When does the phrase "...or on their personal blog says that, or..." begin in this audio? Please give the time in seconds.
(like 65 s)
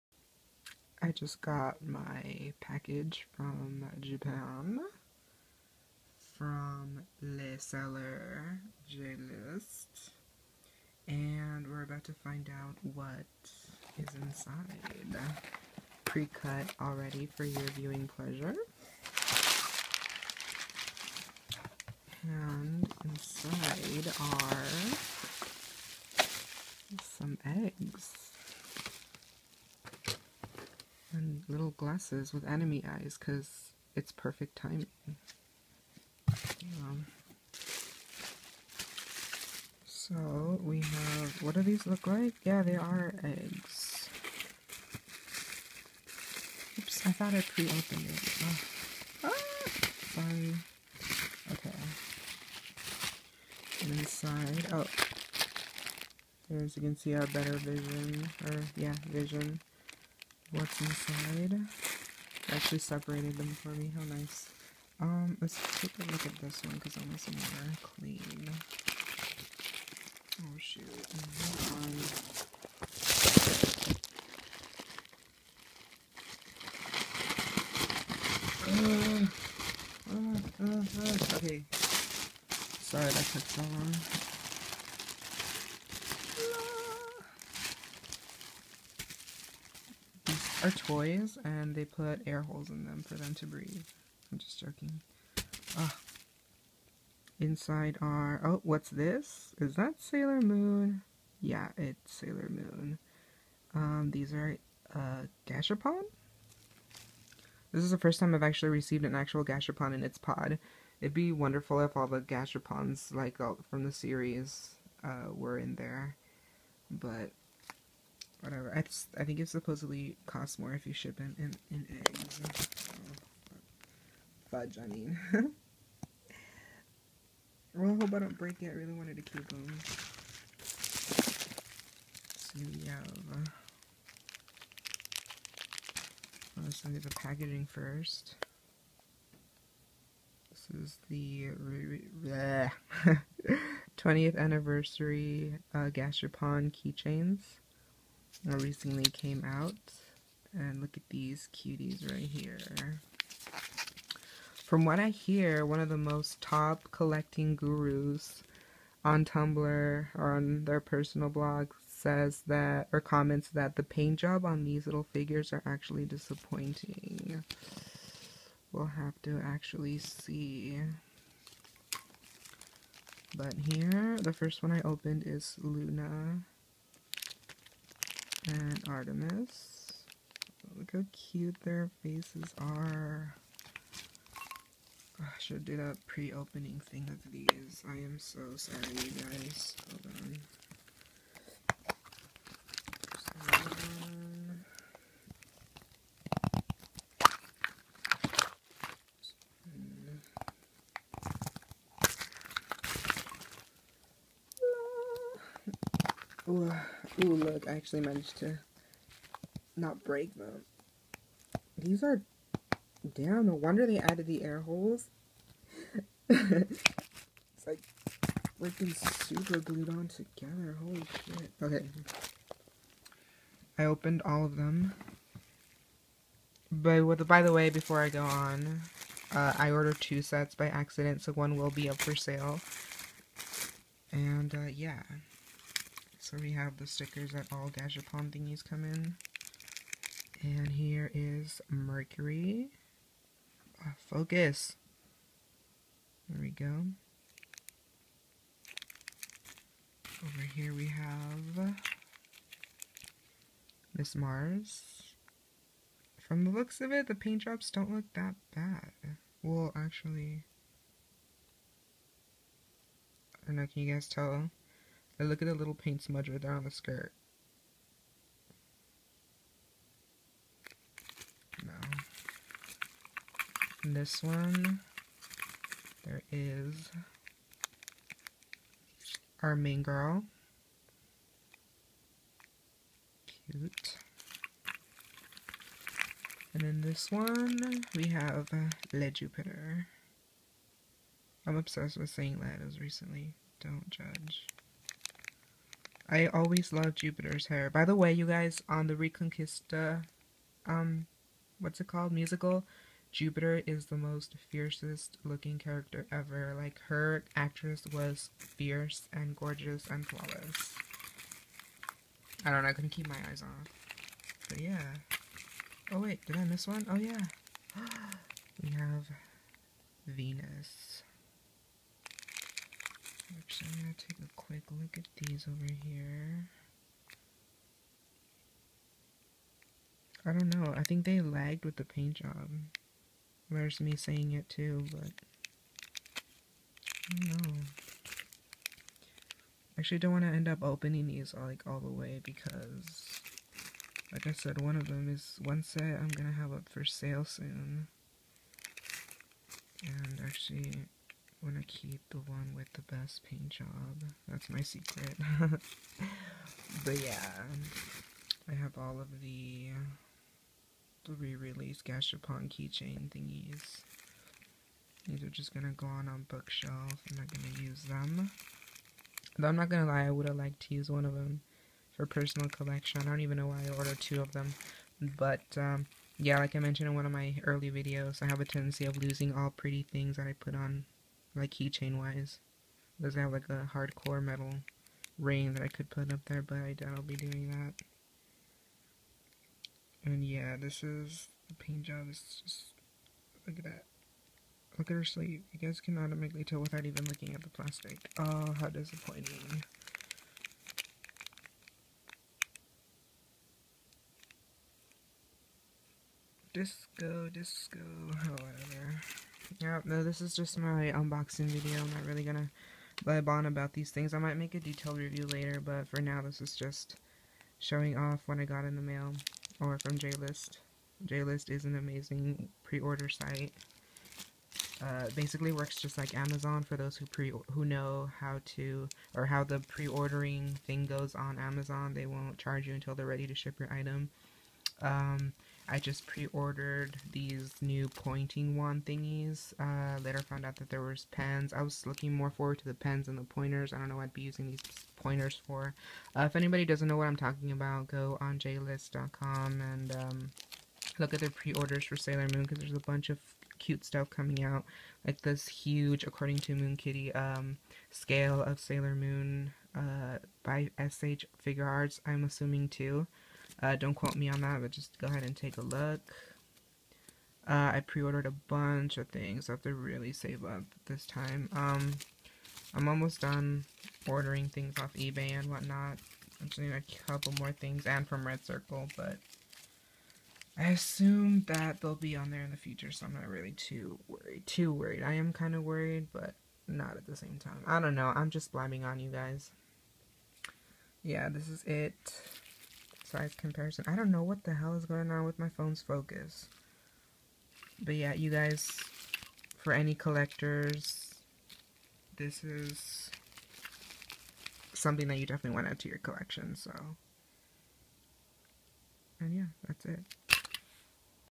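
160 s.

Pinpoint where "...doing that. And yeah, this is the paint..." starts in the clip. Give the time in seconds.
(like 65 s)
387 s.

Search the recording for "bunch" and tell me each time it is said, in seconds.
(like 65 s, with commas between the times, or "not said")
452 s, 468 s.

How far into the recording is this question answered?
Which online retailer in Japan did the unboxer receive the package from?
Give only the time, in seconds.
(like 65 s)
8 s.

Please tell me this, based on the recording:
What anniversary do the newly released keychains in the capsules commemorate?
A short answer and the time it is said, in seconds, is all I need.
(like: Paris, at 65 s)
20th anniversary, at 143 s.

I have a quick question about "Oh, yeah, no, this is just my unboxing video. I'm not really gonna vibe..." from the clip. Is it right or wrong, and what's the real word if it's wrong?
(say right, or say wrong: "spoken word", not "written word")
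right.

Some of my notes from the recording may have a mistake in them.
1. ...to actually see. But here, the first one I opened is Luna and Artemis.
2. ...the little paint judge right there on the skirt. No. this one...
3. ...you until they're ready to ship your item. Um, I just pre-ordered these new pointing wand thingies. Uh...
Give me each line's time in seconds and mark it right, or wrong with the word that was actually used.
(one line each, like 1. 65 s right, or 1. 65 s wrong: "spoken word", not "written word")
1. 169 s right
2. 265 s wrong: "smudge", not "judge"
3. 432 s right.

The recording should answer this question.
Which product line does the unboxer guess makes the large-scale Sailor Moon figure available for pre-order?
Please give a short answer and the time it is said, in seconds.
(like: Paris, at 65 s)
SH Figuarts, at 460 s.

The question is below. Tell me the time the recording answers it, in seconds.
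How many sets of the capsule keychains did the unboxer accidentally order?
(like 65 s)
229 s.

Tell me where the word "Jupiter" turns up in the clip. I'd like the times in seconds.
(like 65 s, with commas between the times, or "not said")
289 s, 296 s, 303 s.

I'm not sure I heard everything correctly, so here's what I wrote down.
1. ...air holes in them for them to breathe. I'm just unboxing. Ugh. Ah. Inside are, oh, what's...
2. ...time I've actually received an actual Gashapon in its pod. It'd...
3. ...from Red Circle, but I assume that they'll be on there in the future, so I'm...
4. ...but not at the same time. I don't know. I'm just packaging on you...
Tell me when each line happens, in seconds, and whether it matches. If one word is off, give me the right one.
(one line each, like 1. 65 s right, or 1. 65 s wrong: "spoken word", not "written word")
1. 92 s wrong: "joking", not "unboxing"
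2. 108 s right
3. 478 s right
4. 486 s wrong: "blabbing", not "packaging".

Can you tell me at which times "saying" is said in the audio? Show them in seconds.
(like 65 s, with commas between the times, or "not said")
292 s, 333 s.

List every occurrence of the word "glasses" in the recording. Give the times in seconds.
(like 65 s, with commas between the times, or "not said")
31 s.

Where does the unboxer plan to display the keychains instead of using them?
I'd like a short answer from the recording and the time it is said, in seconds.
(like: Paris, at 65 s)
bookshelf, at 366 s.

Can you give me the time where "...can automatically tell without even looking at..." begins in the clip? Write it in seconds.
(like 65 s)
395 s.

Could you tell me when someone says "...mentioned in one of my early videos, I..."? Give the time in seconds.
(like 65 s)
376 s.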